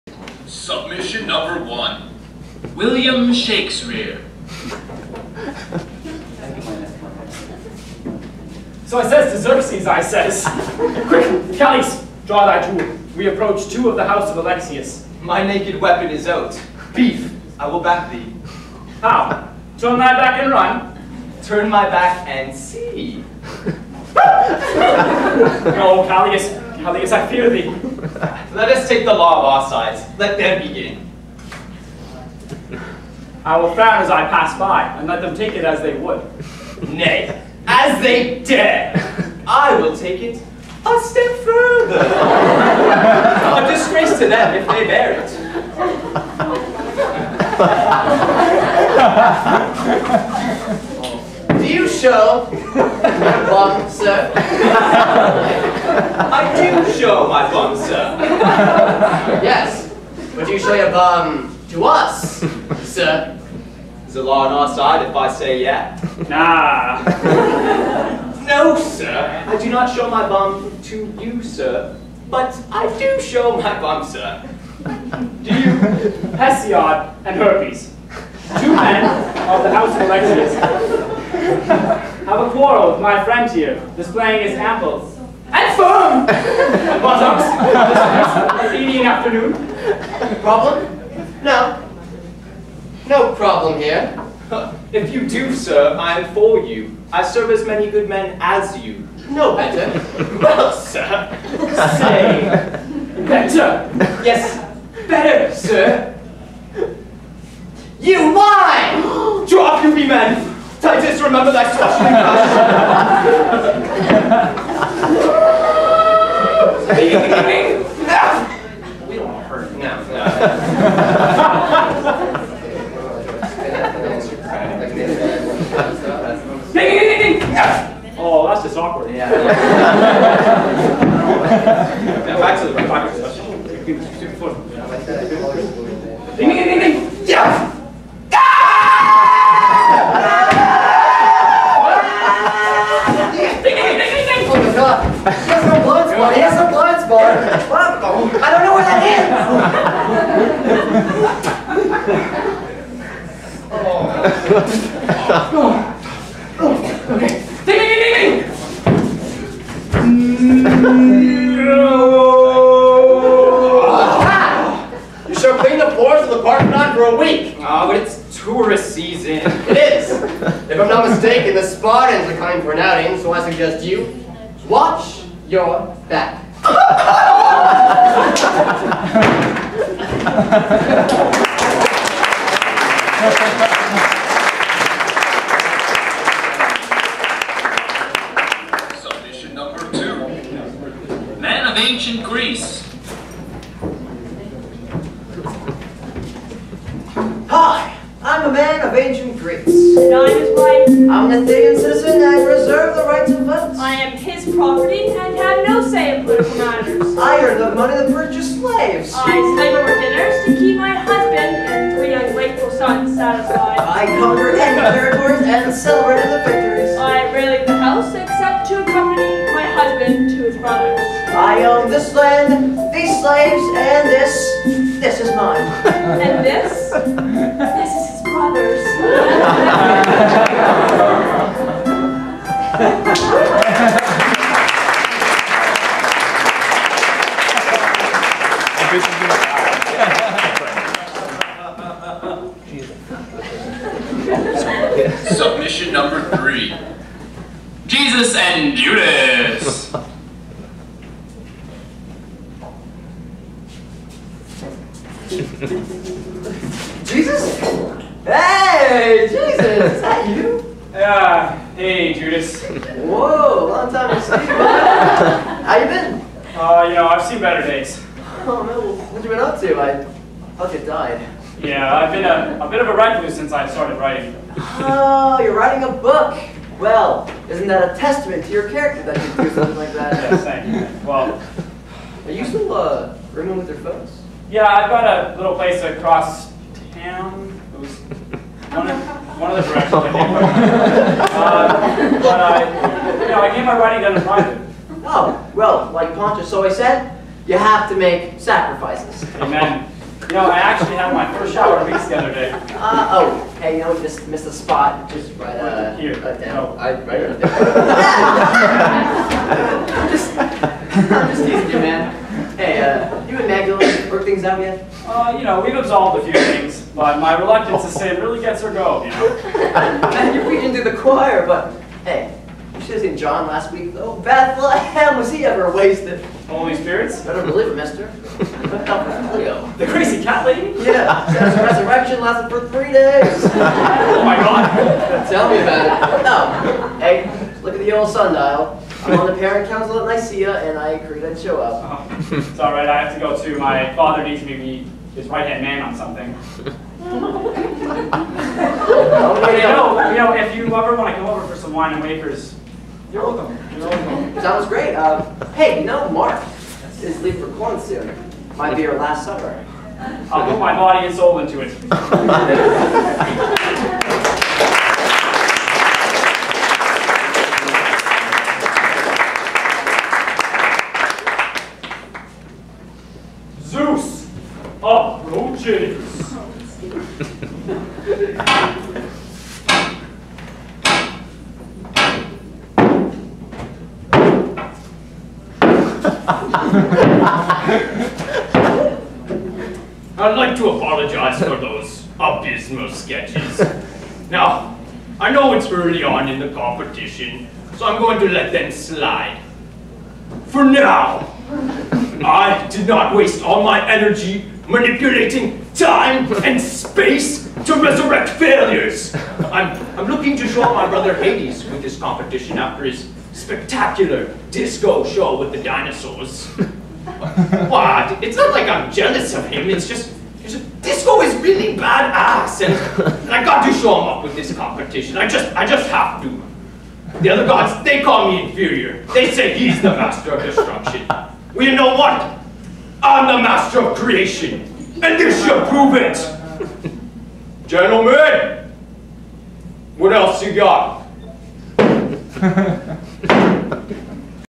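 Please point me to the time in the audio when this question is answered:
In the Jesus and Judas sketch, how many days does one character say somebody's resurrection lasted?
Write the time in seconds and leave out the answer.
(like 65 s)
332 s.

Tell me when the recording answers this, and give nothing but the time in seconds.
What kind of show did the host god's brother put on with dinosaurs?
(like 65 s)
414 s.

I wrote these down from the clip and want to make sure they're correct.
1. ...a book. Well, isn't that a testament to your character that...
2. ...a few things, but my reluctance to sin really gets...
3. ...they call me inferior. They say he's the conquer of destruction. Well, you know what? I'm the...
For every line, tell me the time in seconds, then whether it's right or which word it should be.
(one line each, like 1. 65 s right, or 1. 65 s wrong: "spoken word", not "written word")
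1. 275 s right
2. 316 s right
3. 427 s wrong: "master", not "conquer".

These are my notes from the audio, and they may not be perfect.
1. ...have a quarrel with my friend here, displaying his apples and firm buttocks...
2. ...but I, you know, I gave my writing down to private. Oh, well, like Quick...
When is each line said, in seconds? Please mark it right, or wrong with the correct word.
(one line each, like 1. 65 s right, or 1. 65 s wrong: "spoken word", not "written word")
1. 82 s right
2. 292 s wrong: "Pontius", not "Quick".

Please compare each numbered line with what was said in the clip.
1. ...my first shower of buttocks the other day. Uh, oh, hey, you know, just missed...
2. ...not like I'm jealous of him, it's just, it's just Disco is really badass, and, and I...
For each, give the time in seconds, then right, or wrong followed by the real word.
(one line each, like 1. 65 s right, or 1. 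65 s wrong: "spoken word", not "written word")
1. 301 s wrong: "weeks", not "buttocks"
2. 418 s right.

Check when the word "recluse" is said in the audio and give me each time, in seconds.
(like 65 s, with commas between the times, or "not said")
272 s.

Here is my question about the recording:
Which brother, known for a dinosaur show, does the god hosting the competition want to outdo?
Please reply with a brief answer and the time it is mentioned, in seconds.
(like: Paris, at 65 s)
Hades, at 411 s.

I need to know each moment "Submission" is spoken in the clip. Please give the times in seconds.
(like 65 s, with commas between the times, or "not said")
0 s, 238 s.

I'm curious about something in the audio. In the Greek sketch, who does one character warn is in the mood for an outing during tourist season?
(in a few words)
the Spartans.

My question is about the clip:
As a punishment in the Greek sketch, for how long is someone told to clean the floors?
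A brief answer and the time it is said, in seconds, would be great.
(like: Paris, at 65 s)
a week, at 167 s.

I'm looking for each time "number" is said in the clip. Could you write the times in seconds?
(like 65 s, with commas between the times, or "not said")
1 s, 245 s.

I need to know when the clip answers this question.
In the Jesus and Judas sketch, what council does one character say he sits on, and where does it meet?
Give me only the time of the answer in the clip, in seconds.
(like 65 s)
339 s.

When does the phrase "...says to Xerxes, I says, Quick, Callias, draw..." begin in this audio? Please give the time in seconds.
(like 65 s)
9 s.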